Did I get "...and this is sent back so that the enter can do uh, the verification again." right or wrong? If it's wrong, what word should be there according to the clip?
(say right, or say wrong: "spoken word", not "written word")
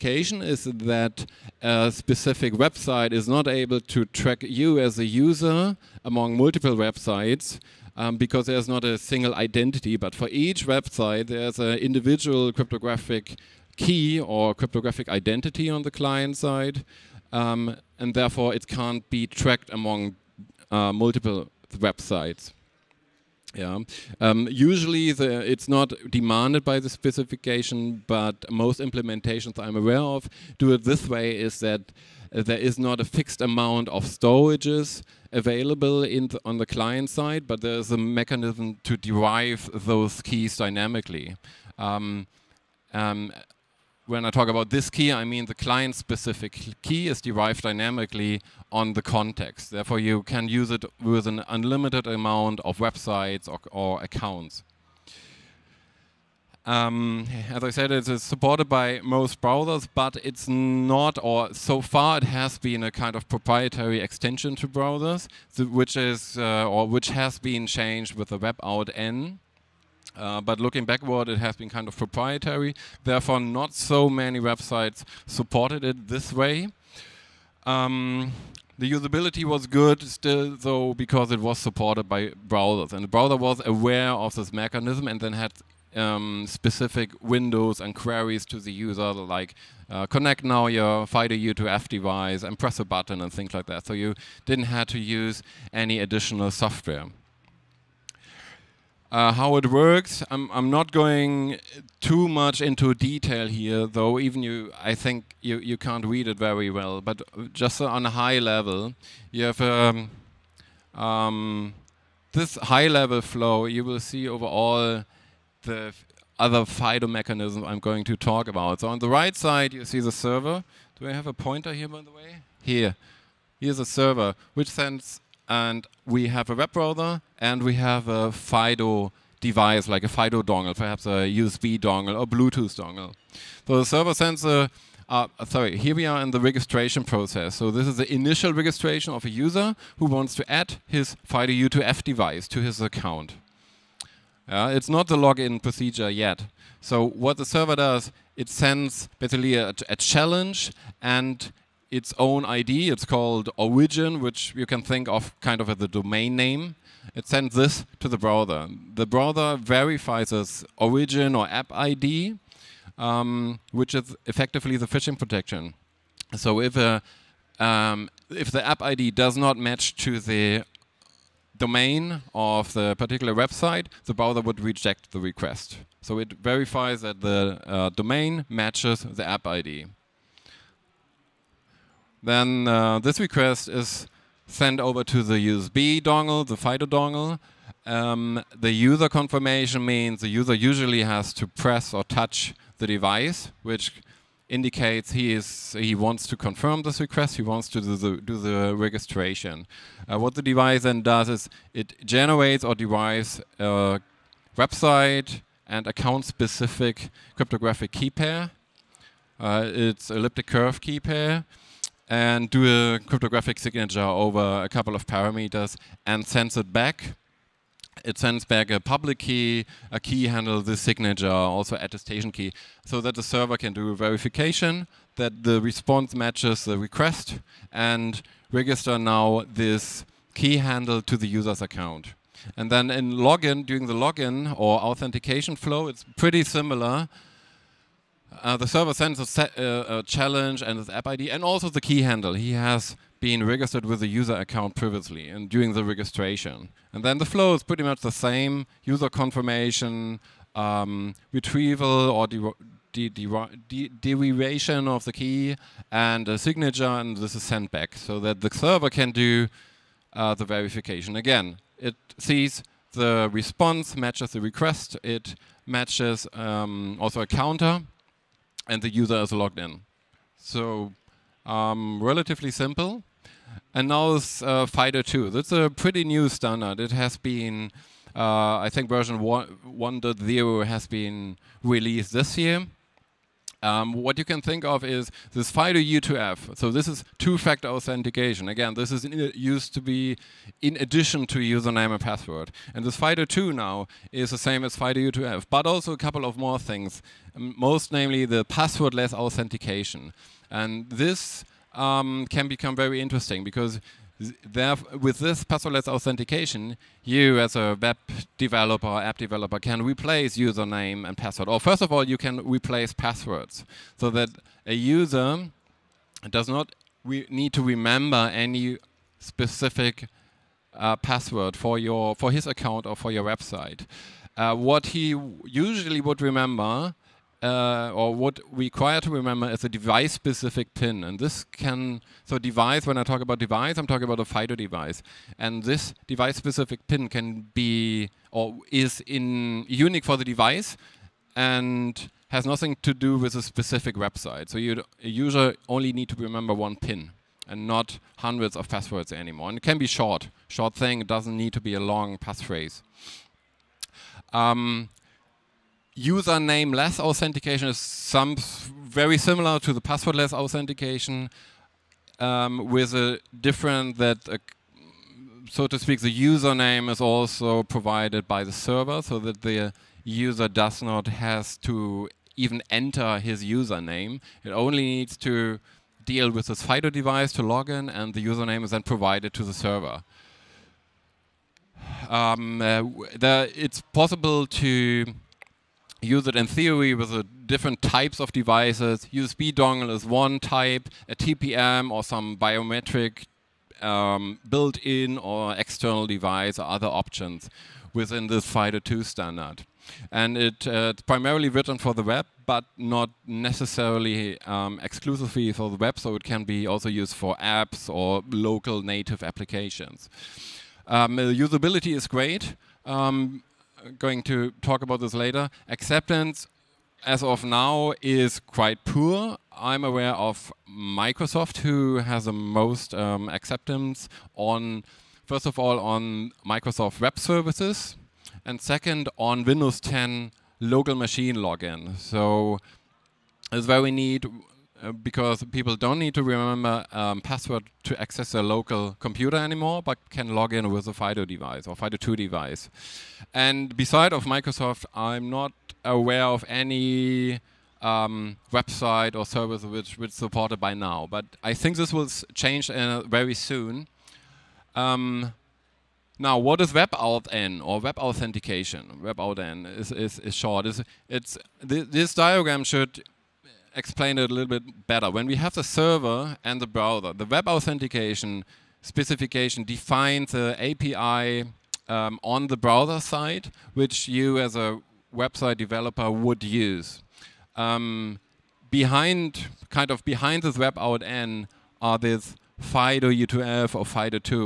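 wrong: "server", not "enter".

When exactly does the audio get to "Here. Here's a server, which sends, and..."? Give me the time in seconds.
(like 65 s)
122 s.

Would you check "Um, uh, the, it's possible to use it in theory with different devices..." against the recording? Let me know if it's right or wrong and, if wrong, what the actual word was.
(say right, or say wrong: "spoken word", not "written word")
wrong: "types", not "devices".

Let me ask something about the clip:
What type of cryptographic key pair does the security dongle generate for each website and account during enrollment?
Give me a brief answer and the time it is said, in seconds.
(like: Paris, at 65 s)
elliptic curve, at 210 s.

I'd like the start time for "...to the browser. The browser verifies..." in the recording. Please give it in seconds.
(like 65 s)
157 s.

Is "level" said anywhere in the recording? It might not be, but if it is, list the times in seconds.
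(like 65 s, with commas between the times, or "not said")
108 s, 112 s.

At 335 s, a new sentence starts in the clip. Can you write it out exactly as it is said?
And this device-specific pin can be, or is in unique for the device and has nothing to do with a specific website.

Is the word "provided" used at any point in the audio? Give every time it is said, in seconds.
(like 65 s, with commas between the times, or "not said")
367 s, 378 s.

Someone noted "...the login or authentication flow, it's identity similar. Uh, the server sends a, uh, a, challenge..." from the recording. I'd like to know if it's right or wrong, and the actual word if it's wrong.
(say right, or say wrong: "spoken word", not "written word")
wrong: "pretty", not "identity".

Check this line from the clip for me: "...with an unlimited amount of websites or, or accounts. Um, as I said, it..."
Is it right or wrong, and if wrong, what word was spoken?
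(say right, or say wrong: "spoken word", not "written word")
right.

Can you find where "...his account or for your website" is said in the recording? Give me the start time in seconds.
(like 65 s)
322 s.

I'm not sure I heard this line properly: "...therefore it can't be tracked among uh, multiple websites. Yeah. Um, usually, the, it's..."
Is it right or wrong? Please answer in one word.
right.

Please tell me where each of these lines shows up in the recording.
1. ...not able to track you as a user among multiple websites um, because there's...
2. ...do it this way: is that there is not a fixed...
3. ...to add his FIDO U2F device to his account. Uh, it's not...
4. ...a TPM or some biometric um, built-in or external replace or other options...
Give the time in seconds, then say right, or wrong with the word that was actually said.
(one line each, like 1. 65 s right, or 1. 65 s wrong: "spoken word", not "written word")
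1. 3 s right
2. 30 s right
3. 140 s right
4. 391 s wrong: "device", not "replace".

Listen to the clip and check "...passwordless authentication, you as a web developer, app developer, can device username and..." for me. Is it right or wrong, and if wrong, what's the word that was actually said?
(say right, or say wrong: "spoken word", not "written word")
wrong: "replace", not "device".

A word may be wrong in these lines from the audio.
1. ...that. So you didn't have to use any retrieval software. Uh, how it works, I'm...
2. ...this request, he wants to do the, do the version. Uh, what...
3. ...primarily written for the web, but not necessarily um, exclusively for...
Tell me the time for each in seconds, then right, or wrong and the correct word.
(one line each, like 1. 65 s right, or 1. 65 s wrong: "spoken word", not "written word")
1. 93 s wrong: "additional", not "retrieval"
2. 196 s wrong: "registration", not "version"
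3. 401 s right.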